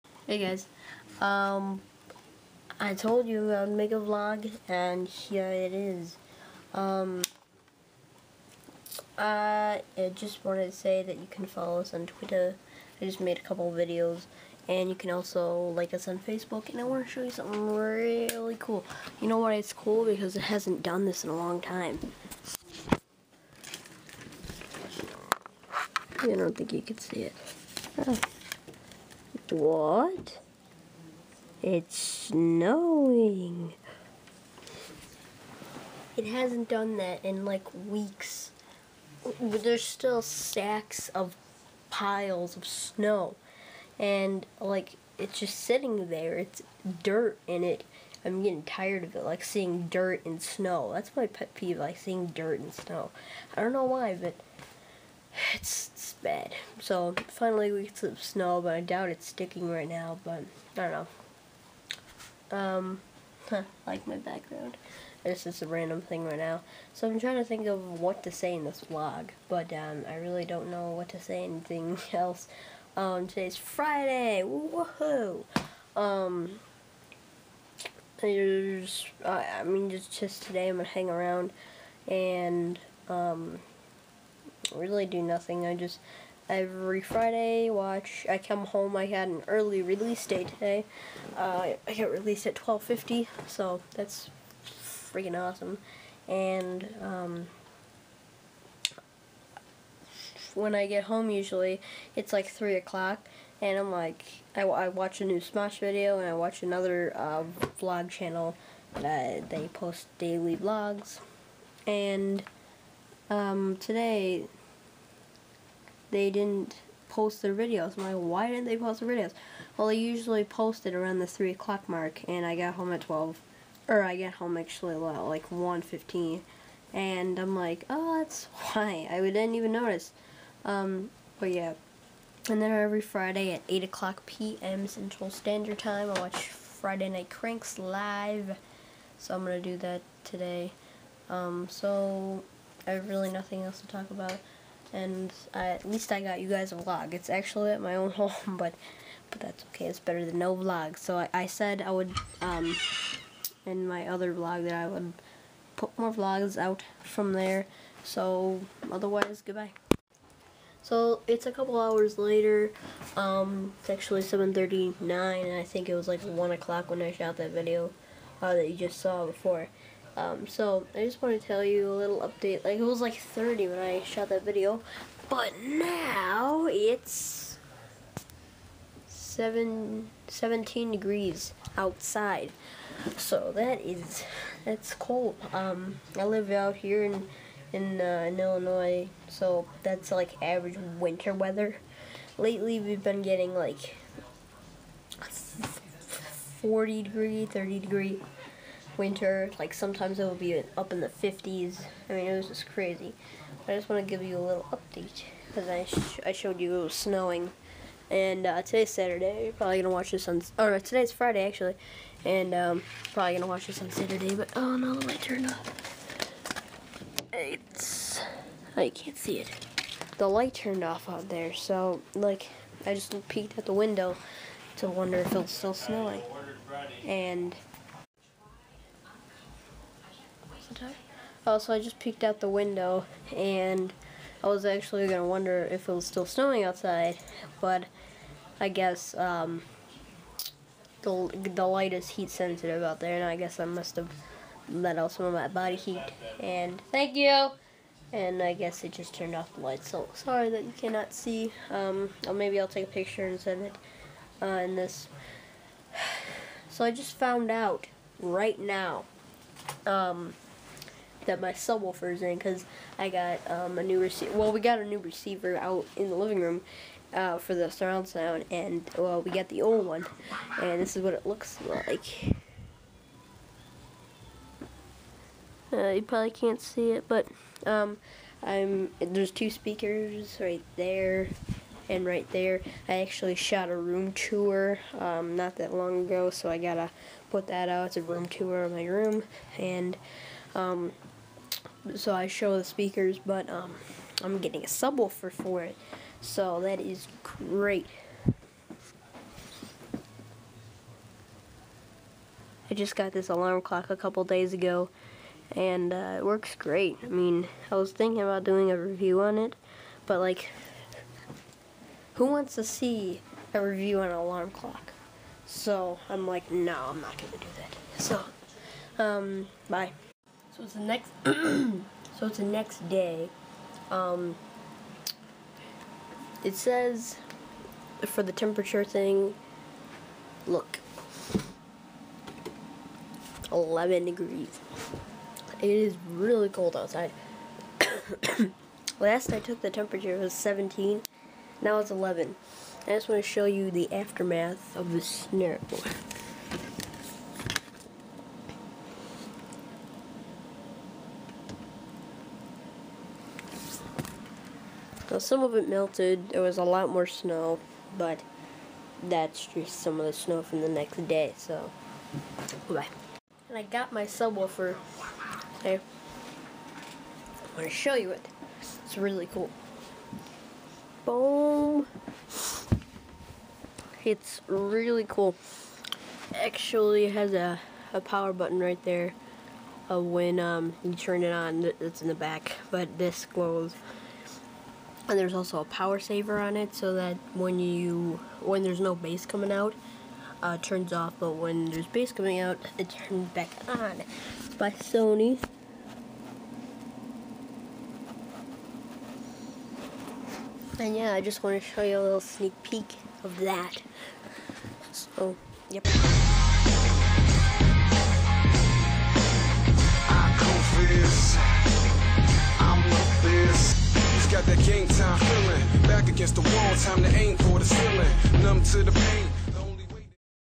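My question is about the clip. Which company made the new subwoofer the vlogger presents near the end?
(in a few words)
Sony.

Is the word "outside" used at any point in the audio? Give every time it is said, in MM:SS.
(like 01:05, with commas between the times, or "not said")
03:01, 03:56, 05:36.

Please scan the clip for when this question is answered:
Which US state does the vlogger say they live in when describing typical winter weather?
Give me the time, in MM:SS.
03:08.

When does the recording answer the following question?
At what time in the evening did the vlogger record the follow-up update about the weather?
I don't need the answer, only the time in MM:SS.
02:44.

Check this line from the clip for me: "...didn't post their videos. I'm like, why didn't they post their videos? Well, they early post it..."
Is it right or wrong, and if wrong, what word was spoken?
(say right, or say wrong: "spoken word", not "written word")
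wrong: "usually", not "early".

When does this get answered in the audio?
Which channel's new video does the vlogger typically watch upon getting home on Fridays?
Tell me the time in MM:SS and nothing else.
01:45.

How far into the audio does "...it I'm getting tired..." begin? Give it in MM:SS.
00:47.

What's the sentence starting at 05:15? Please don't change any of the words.
So I'm like, no, I'm not gonna do that.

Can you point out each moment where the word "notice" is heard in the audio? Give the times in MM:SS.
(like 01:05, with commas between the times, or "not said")
02:09.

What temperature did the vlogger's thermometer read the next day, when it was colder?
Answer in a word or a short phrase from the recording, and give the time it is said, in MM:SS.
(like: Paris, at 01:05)
11 degrees, at 05:33.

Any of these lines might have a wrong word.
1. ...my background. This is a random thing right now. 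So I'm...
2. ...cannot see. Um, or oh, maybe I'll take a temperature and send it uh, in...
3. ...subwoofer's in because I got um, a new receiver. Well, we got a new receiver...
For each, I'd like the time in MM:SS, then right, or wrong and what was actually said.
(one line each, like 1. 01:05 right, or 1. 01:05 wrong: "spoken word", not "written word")
1. 01:04 right
2. 04:10 wrong: "picture", not "temperature"
3. 04:21 right.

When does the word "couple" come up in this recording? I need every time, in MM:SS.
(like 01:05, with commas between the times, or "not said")
00:13, 02:41, 05:03.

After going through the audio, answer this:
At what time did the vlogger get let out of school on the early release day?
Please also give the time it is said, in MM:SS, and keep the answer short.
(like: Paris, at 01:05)
12:50, at 01:32.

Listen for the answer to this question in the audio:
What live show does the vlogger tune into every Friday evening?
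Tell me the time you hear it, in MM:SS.
02:16.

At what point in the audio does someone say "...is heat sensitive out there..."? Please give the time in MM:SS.
04:01.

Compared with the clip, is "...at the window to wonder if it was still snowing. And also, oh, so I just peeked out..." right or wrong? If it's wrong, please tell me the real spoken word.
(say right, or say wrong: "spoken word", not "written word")
right.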